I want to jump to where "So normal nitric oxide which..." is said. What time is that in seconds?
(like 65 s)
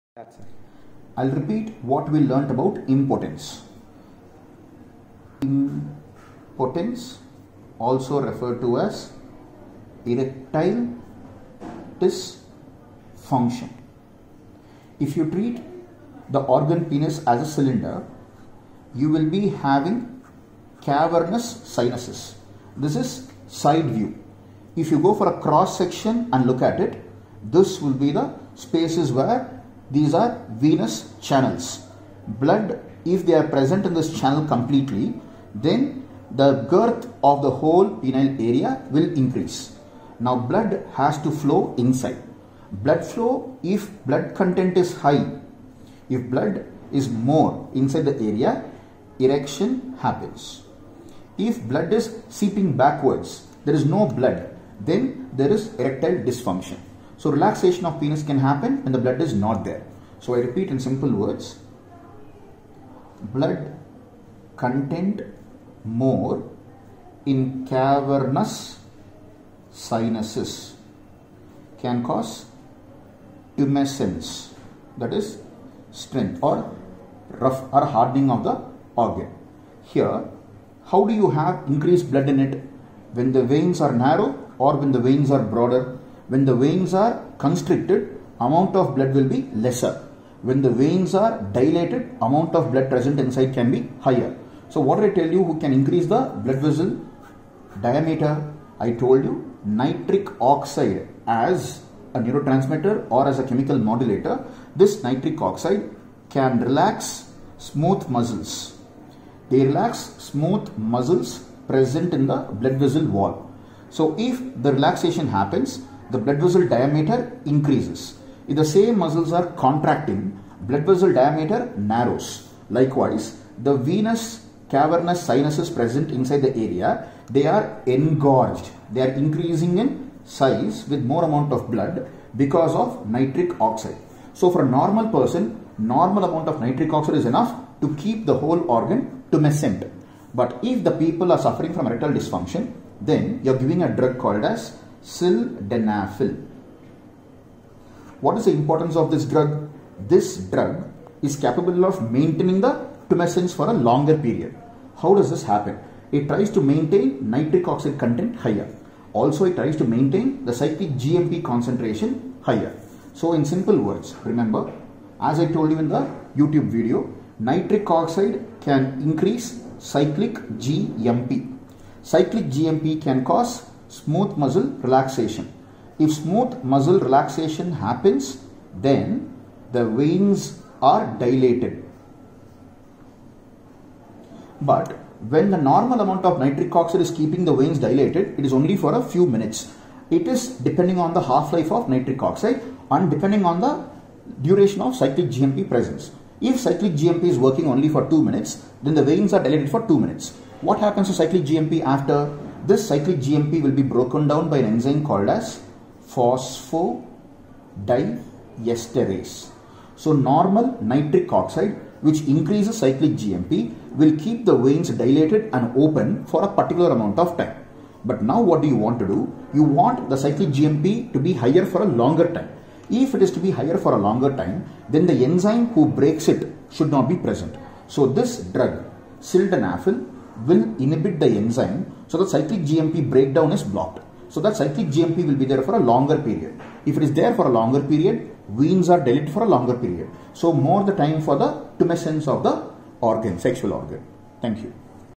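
209 s.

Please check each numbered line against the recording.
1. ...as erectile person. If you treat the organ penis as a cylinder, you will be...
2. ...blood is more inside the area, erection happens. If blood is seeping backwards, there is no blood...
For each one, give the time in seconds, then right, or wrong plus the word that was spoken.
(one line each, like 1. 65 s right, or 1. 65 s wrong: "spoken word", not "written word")
1. 8 s wrong: "dysfunction", not "person"
2. 46 s right.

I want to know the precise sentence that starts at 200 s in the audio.
What happens to cyclic GMP after this cyclic GMP will be broken down by an enzyme called as phosphodiesterase.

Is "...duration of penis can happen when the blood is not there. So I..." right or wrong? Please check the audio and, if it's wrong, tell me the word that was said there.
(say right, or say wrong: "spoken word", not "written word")
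wrong: "relaxation", not "duration".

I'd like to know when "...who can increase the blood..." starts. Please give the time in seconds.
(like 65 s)
95 s.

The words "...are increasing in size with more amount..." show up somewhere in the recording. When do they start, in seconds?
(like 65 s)
129 s.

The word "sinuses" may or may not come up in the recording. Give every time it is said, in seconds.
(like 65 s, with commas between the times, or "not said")
21 s, 69 s, 125 s.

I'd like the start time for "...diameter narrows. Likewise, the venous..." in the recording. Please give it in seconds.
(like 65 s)
121 s.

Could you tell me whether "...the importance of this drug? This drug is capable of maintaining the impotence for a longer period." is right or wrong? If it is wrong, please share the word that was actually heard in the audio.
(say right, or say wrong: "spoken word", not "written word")
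wrong: "tumescence", not "impotence".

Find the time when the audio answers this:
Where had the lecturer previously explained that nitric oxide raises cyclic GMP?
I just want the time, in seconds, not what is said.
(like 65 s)
166 s.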